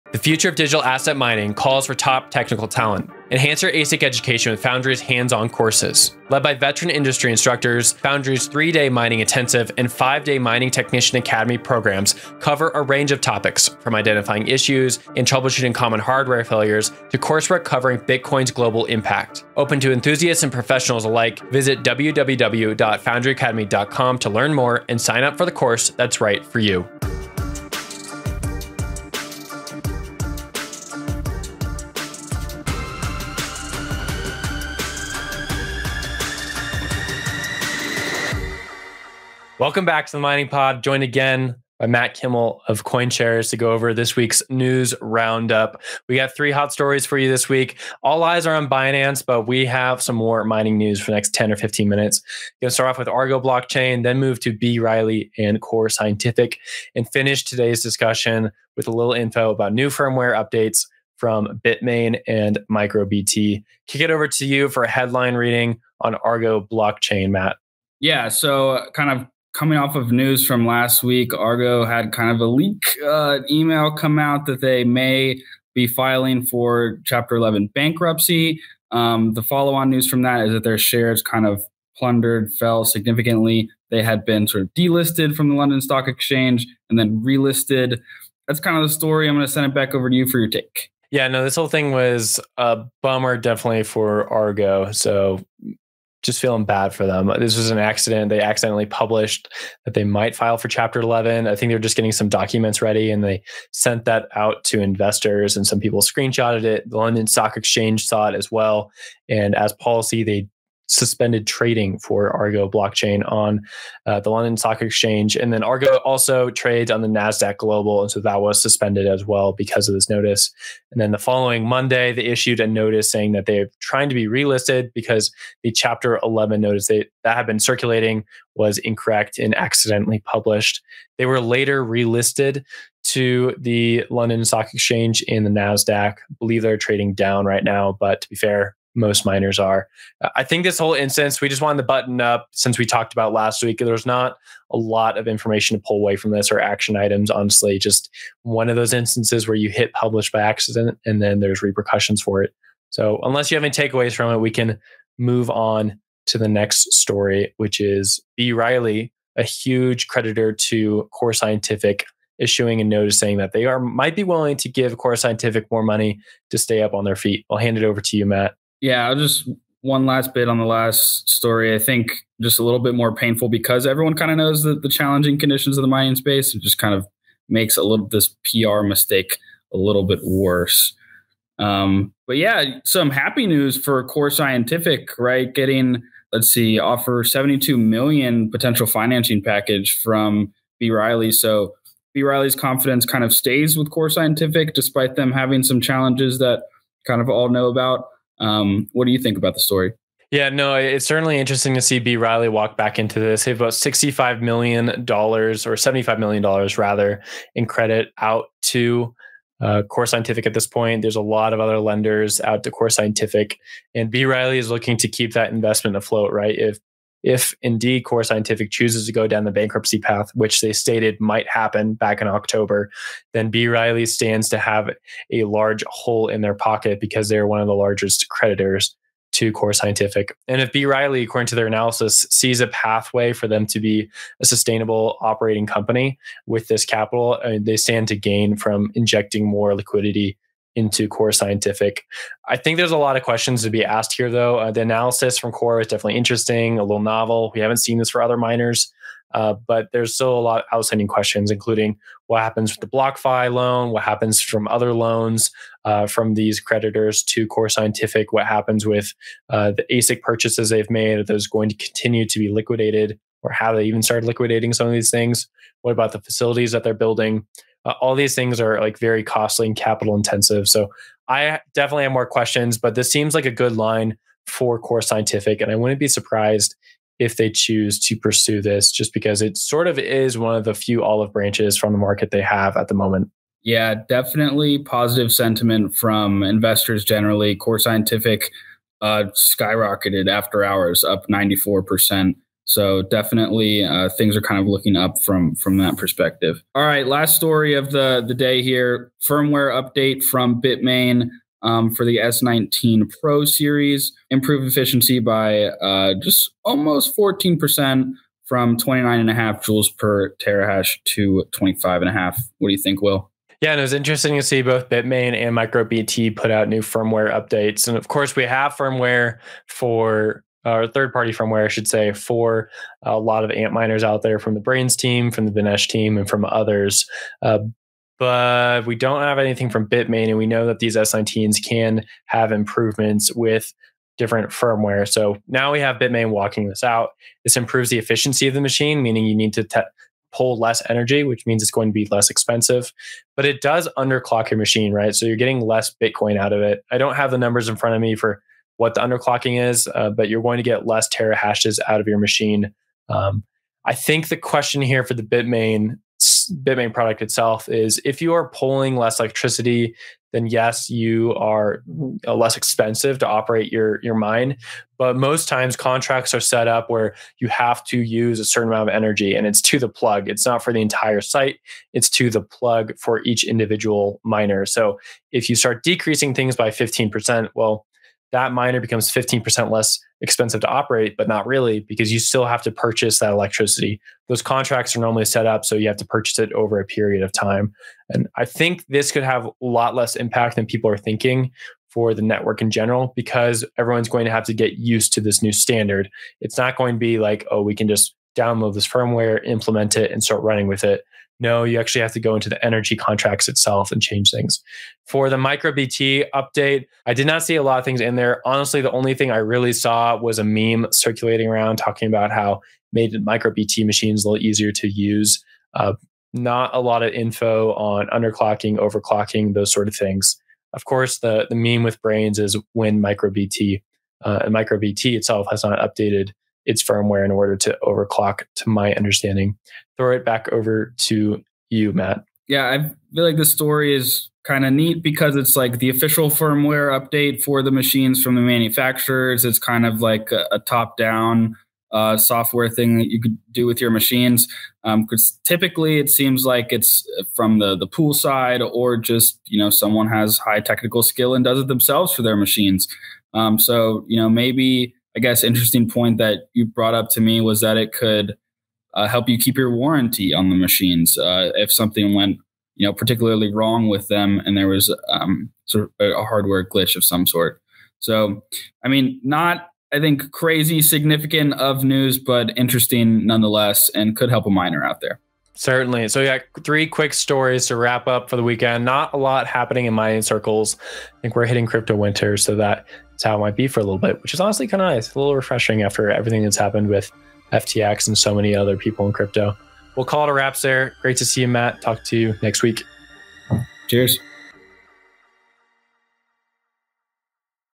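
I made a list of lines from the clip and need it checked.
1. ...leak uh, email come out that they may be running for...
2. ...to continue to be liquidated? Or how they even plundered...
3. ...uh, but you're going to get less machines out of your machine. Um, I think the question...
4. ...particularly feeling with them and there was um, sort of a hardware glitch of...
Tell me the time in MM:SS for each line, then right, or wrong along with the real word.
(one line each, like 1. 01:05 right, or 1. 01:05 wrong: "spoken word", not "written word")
1. 01:12 wrong: "filing", not "running"
2. 04:21 wrong: "started", not "plundered"
3. 05:49 wrong: "terahashes", not "machines"
4. 07:42 wrong: "wrong", not "feeling".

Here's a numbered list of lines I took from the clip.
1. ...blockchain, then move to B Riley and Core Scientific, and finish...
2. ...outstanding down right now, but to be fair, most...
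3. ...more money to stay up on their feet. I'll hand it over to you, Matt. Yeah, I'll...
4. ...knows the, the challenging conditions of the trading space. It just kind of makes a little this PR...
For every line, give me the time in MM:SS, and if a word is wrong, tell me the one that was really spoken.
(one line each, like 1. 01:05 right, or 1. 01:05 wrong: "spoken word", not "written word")
1. 00:53 right
2. 02:16 wrong: "trading", not "outstanding"
3. 02:45 right
4. 02:54 wrong: "mining", not "trading".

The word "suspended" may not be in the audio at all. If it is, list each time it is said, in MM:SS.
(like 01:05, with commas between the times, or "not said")
01:50, 01:58.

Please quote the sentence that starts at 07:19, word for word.
It's kind of like a, a top down uh, software thing that you could do with your machines.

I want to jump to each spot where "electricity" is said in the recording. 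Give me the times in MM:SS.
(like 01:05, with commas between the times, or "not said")
05:59, 06:23.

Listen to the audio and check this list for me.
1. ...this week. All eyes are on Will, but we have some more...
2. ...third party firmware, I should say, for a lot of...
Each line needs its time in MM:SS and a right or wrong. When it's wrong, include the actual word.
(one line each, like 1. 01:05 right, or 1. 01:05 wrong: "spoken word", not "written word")
1. 00:47 wrong: "Binance", not "Will"
2. 05:20 right.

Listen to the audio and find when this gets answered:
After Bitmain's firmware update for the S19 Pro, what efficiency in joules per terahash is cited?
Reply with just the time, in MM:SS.
05:11.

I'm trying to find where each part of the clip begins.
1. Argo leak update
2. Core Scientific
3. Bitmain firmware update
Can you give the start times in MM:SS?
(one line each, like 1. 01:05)
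1. 01:11
2. 03:01
3. 04:59.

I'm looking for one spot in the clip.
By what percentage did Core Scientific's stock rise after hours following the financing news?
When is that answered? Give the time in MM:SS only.
04:51.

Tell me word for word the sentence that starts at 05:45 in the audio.
So you're getting less Bitcoin out of it.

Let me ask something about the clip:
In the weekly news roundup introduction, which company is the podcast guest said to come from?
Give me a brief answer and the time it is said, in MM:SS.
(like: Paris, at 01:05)
CoinShares, at 00:42.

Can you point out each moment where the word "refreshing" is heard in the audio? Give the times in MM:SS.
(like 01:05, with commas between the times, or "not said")
08:05.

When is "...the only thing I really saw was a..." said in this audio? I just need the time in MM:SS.
06:48.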